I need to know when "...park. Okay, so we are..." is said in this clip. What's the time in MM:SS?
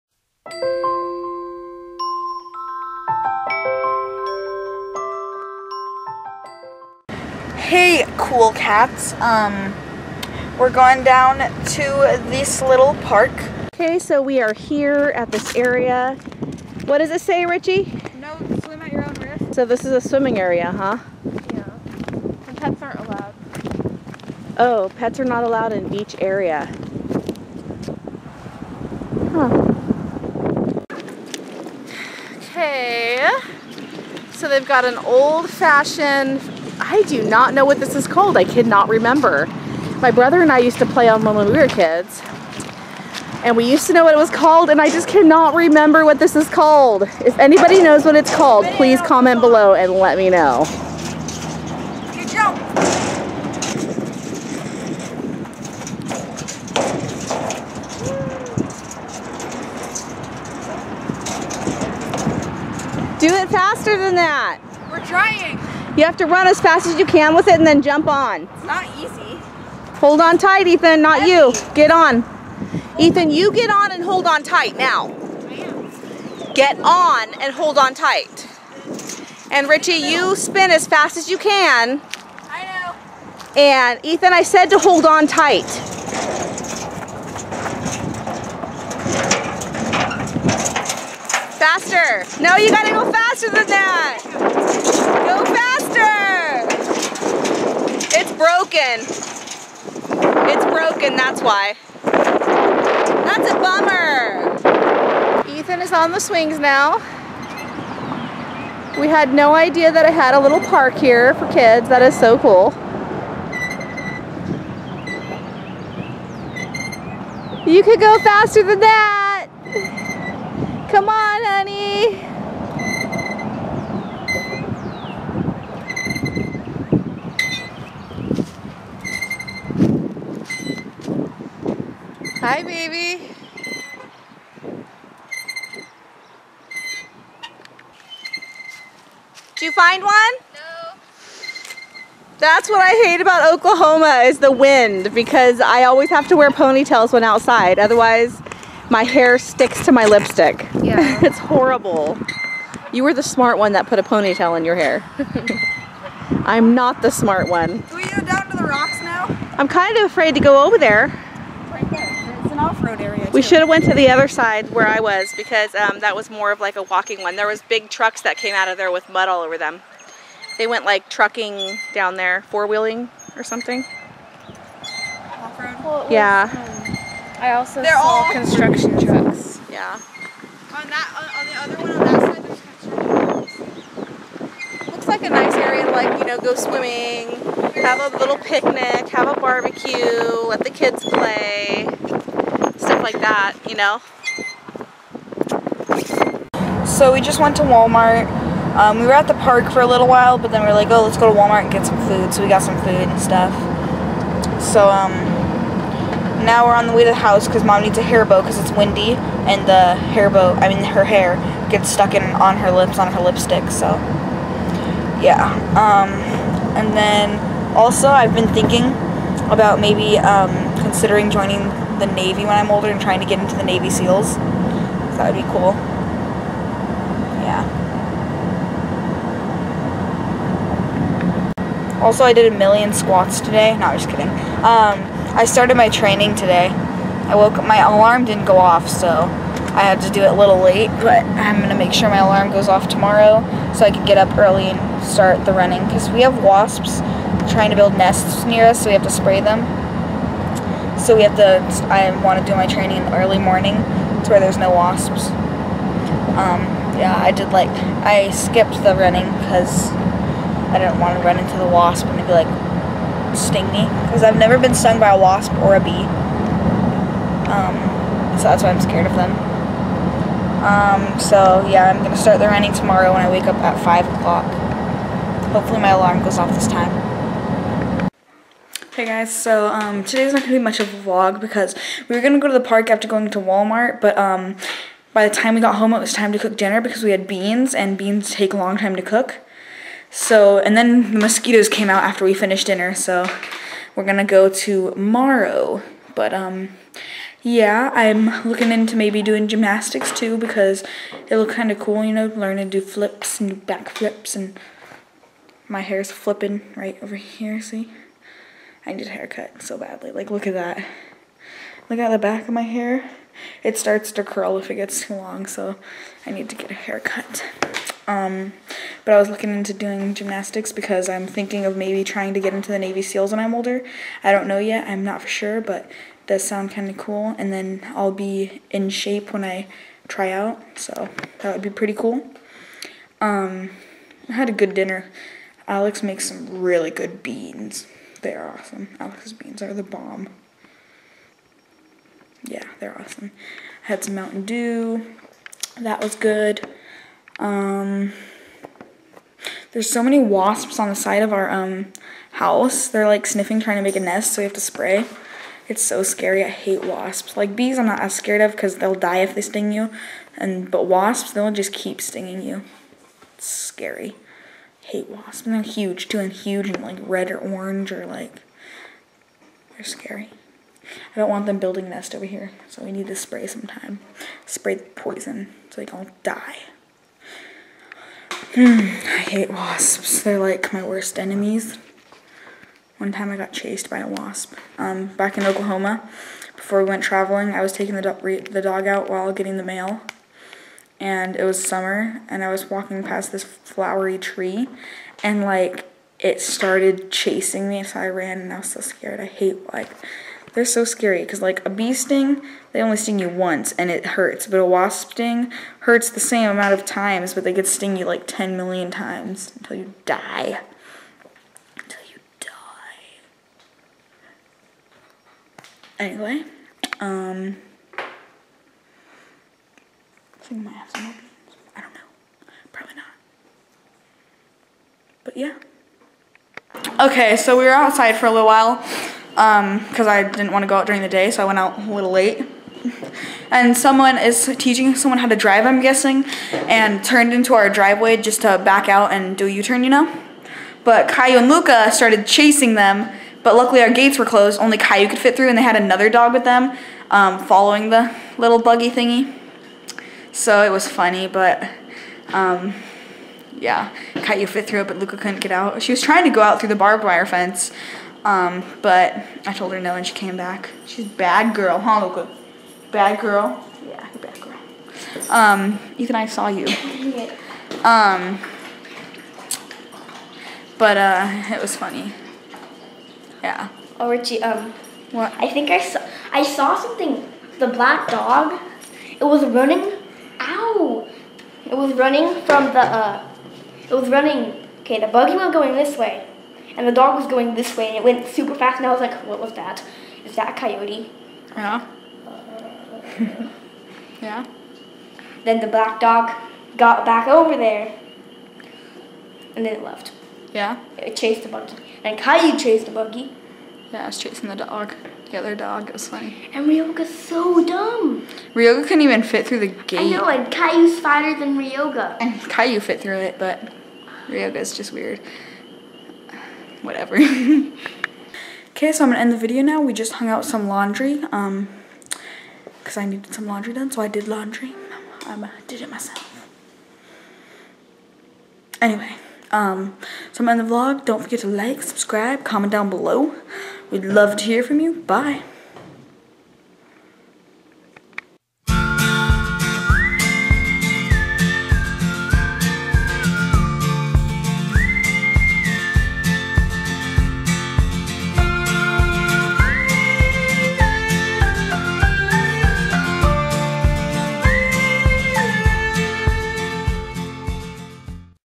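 00:13.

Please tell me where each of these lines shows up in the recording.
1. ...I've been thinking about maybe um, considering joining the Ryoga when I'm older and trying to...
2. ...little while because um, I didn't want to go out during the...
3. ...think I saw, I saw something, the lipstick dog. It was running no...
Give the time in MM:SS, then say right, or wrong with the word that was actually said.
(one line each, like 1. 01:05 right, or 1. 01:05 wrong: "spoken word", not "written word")
1. 03:38 wrong: "Navy", not "Ryoga"
2. 07:08 right
3. 07:55 wrong: "black", not "lipstick".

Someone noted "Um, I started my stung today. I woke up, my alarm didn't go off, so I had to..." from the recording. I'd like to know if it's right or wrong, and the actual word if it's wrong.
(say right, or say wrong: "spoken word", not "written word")
wrong: "training", not "stung".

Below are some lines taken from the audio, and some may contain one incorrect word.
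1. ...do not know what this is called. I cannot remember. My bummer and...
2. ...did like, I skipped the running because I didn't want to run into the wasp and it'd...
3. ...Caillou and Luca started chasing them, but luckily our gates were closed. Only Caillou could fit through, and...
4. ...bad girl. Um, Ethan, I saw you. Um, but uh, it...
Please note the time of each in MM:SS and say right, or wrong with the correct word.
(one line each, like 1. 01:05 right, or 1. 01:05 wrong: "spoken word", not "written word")
1. 00:37 wrong: "brother", not "bummer"
2. 04:17 right
3. 07:21 right
4. 07:44 right.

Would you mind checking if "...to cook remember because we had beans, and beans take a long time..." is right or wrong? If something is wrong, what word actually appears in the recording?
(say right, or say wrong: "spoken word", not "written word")
wrong: "dinner", not "remember".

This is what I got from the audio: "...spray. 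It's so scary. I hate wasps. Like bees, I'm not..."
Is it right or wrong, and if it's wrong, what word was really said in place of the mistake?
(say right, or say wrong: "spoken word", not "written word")
right.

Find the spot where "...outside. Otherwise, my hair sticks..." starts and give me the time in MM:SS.
02:27.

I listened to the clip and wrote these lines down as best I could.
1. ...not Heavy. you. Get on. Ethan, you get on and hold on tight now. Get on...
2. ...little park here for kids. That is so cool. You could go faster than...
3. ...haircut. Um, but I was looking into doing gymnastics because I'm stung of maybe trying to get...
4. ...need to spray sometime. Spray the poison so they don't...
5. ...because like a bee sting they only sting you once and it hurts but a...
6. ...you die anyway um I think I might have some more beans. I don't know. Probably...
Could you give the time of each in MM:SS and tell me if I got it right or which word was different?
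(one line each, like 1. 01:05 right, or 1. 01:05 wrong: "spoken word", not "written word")
1. 01:10 right
2. 01:50 right
3. 05:16 wrong: "thinking", not "stung"
4. 06:12 right
5. 06:41 right
6. 06:52 right.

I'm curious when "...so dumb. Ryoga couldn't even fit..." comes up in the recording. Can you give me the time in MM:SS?
08:27.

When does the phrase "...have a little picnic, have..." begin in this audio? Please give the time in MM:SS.
03:07.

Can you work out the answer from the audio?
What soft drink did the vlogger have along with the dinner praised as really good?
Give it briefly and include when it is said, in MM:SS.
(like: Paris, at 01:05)
Mountain Dew, at 05:44.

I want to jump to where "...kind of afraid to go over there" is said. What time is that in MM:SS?
02:39.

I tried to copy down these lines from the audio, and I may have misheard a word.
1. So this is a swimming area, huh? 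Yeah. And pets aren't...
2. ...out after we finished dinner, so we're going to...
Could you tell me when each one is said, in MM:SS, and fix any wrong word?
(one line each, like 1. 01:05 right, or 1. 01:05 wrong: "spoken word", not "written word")
1. 00:19 right
2. 04:51 right.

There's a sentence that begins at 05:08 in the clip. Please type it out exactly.
I need a haircut so badly.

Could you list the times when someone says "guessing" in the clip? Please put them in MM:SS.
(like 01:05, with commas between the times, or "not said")
07:15.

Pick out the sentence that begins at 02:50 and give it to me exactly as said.
They went like trucking down there, four-wheeling or something.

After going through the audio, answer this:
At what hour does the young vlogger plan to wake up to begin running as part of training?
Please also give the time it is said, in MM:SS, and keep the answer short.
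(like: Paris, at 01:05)
5 o'clock, at 04:33.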